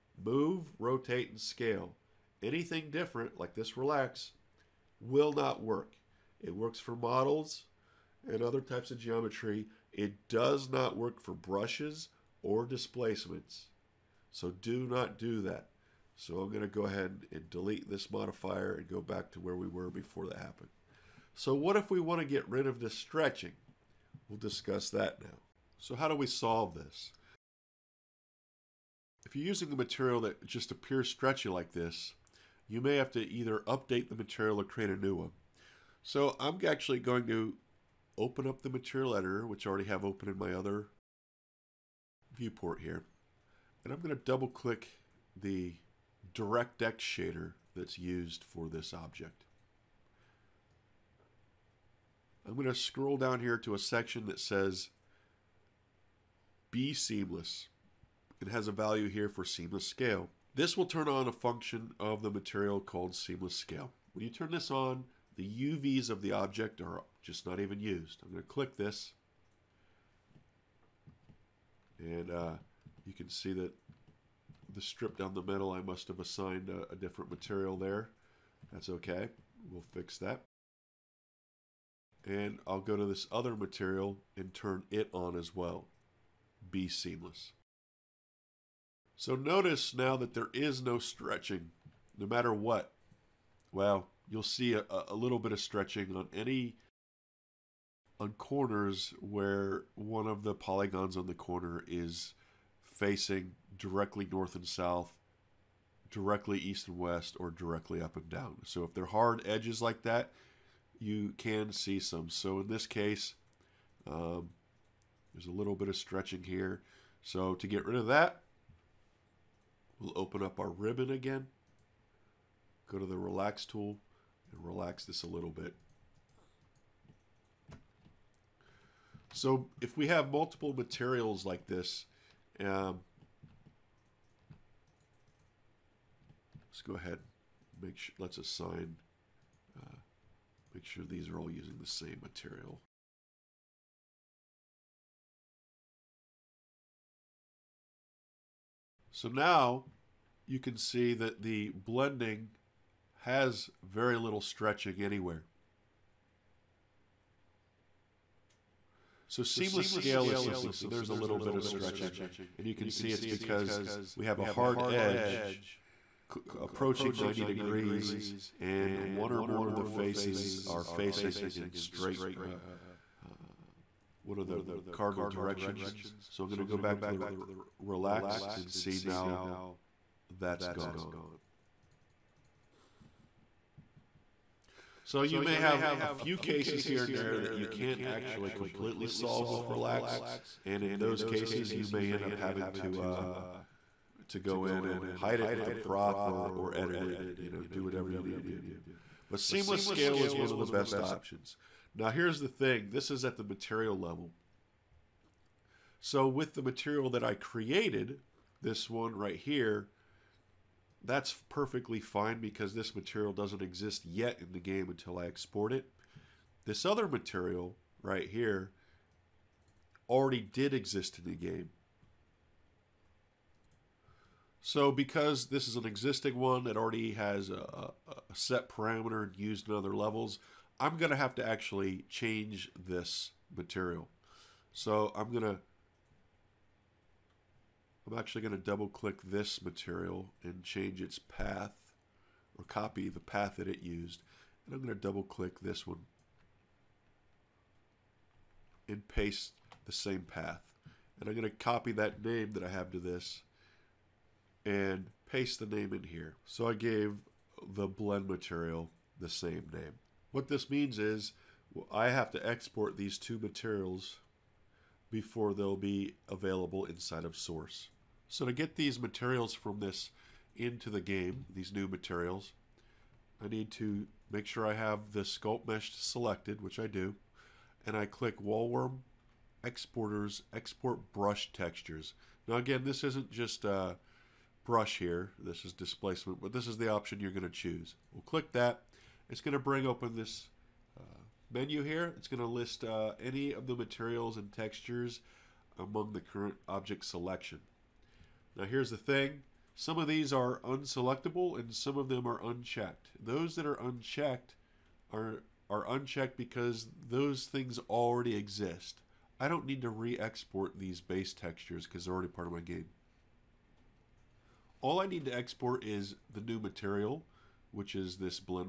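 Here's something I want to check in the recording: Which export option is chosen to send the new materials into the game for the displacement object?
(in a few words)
Export Brush Textures.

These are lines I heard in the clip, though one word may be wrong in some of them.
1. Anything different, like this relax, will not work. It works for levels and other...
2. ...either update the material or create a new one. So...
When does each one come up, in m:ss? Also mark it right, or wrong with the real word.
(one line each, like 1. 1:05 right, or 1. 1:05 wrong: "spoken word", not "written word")
1. 0:02 wrong: "models", not "levels"
2. 0:33 right.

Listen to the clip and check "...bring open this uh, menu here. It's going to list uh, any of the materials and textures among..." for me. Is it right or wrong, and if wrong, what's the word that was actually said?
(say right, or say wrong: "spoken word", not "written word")
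right.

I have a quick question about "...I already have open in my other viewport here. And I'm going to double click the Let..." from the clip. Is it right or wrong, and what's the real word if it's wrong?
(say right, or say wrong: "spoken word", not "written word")
wrong: "DirectX", not "Let".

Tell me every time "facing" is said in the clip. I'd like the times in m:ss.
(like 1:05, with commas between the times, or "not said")
1:42, 2:50.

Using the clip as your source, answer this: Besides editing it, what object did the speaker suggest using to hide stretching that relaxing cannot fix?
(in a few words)
a prop.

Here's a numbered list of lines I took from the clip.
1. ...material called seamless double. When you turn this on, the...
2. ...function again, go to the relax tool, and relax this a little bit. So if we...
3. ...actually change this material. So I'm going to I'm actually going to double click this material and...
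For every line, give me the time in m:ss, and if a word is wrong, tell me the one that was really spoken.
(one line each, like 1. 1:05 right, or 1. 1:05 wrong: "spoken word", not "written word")
1. 1:02 wrong: "scale", not "double"
2. 2:00 wrong: "ribbon", not "function"
3. 3:51 right.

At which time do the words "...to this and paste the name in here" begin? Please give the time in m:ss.
4:12.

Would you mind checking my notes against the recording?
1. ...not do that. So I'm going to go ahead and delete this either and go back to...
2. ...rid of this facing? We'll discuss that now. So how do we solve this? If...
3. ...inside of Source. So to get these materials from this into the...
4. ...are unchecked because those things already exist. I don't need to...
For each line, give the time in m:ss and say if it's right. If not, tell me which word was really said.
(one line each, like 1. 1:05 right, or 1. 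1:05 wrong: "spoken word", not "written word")
1. 0:14 wrong: "modifier", not "either"
2. 0:22 wrong: "stretching", not "facing"
3. 4:26 right
4. 5:05 right.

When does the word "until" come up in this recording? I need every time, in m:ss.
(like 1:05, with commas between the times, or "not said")
3:34.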